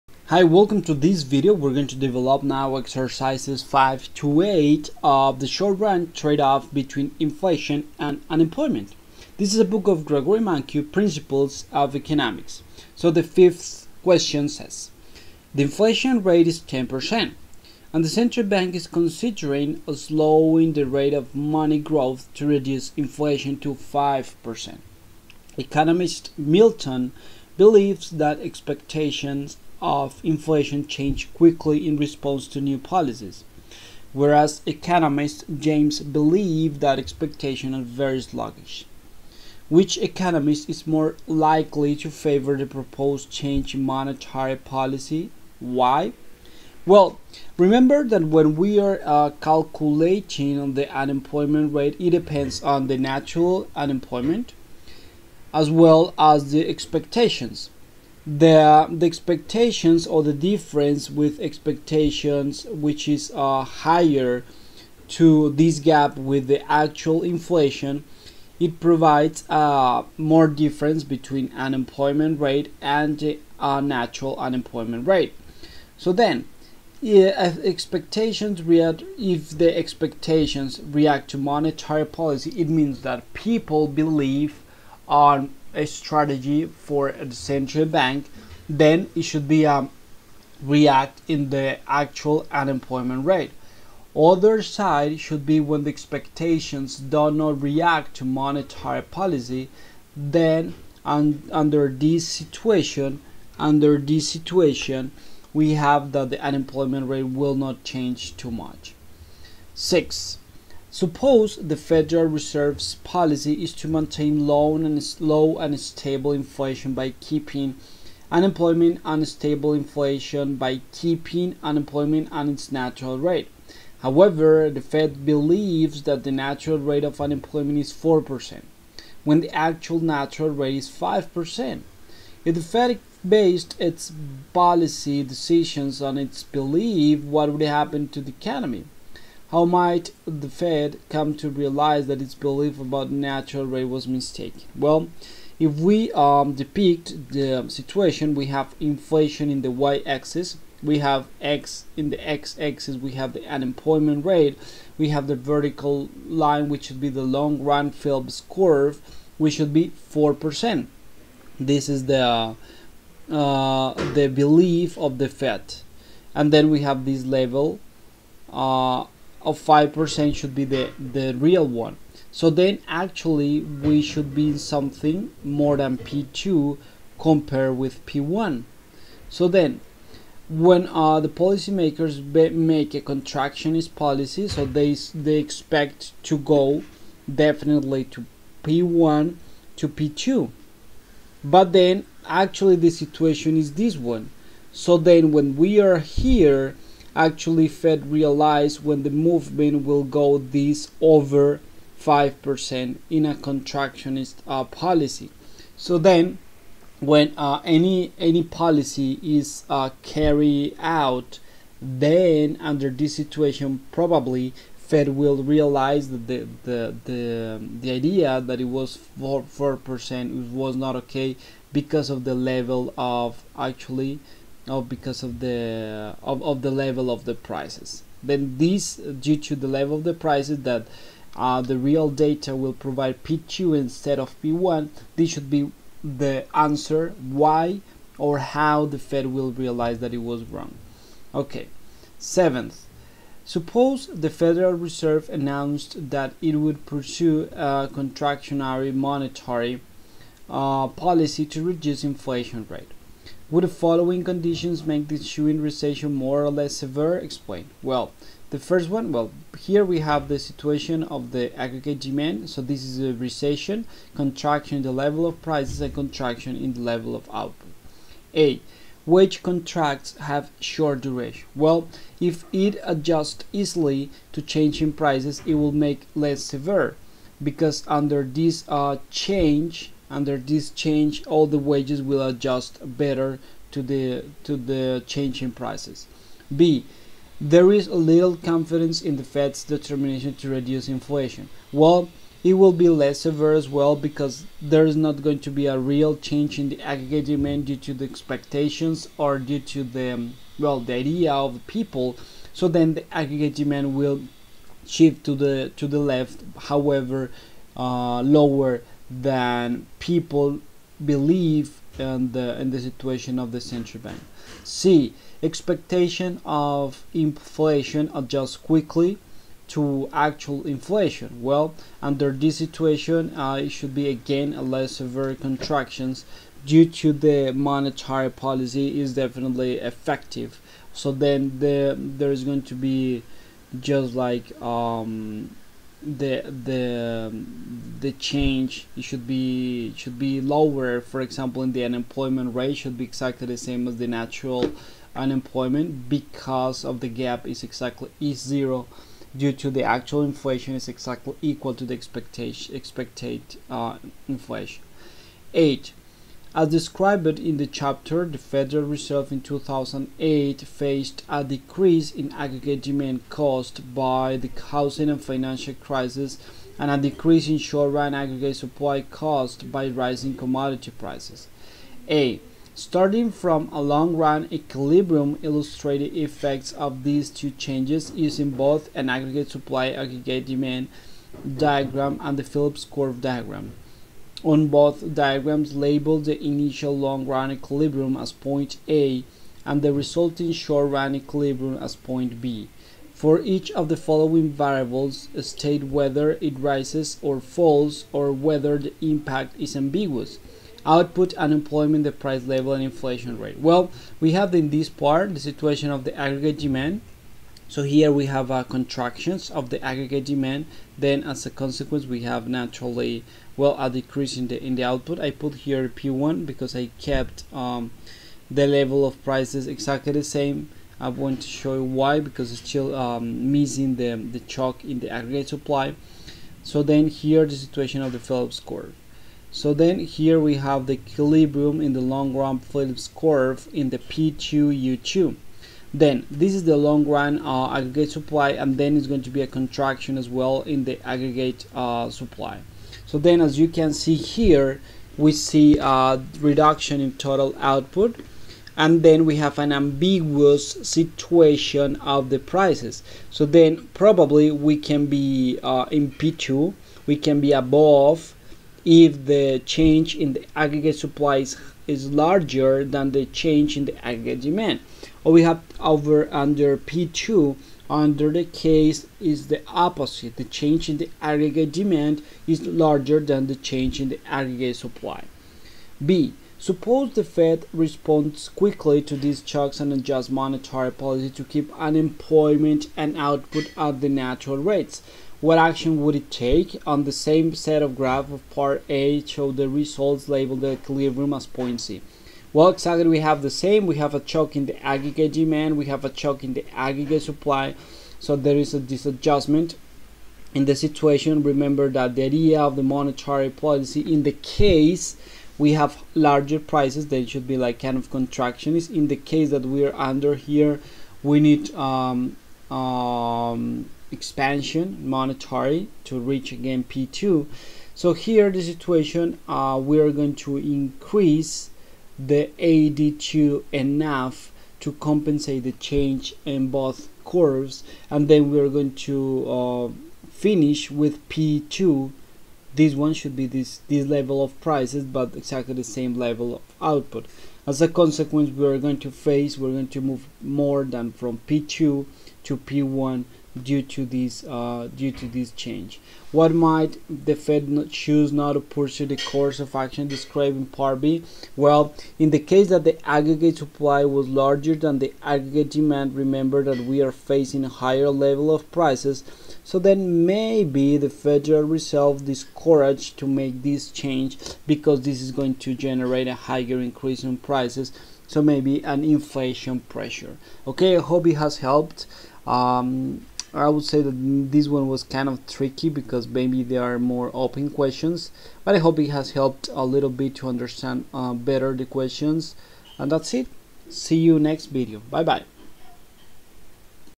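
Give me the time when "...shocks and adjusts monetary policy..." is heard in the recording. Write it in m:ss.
7:59.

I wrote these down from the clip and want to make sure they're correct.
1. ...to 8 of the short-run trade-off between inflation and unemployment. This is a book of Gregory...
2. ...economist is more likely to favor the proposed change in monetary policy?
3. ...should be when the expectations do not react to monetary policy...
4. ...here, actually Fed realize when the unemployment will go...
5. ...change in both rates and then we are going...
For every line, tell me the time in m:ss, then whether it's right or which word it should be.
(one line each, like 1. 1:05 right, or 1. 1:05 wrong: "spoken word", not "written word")
1. 0:04 right
2. 0:39 right
3. 1:35 right
4. 3:15 wrong: "movement", not "unemployment"
5. 8:45 wrong: "curves", not "rates".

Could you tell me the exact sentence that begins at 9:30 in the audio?
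Okay, I hope it has helped.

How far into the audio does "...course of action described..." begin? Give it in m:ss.
9:09.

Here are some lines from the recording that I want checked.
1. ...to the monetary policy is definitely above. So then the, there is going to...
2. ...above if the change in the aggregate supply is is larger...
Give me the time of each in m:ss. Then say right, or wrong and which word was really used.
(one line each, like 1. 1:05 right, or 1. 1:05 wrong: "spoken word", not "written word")
1. 5:26 wrong: "effective", not "above"
2. 7:37 right.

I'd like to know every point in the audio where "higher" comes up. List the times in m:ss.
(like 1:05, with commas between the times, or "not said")
1:03, 9:17, 9:26.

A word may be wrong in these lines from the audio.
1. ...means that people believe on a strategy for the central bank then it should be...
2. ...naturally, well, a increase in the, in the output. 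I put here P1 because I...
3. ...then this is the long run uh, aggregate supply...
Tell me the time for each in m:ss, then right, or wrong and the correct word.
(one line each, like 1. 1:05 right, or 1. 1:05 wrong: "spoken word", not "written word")
1. 1:22 right
2. 6:52 wrong: "decrease", not "increase"
3. 7:15 right.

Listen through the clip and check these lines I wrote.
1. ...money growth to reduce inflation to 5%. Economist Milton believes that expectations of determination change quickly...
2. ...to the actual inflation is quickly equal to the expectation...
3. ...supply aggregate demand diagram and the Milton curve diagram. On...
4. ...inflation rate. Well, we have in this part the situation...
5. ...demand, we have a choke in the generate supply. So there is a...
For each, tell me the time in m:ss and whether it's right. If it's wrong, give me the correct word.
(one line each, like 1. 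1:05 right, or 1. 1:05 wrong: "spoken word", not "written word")
1. 0:21 wrong: "inflation", not "determination"
2. 5:49 wrong: "exactly", not "quickly"
3. 6:19 wrong: "Phillips", not "Milton"
4. 6:42 right
5. 8:15 wrong: "aggregate", not "generate".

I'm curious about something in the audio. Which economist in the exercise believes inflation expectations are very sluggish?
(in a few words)
James.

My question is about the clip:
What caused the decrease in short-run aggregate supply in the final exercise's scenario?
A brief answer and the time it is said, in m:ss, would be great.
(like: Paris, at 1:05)
rising commodity prices, at 6:09.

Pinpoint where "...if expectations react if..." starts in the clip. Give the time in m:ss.
1:17.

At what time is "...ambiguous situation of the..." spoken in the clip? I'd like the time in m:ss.
7:29.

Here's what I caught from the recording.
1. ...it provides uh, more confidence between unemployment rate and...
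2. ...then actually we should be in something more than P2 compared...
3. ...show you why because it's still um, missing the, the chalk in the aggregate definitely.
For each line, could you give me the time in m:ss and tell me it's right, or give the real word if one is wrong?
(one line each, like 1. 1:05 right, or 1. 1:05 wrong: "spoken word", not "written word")
1. 1:08 wrong: "difference", not "confidence"
2. 2:52 right
3. 7:01 wrong: "supply", not "definitely".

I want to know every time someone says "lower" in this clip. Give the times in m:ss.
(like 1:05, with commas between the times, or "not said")
5:08, 5:40.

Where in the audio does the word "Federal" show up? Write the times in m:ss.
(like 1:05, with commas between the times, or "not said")
1:51, 4:04, 5:58, 9:21.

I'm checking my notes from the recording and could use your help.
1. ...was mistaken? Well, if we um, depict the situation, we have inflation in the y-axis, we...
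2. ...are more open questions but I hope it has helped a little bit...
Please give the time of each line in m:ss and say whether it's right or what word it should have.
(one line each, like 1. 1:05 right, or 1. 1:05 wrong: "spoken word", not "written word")
1. 2:23 right
2. 9:36 right.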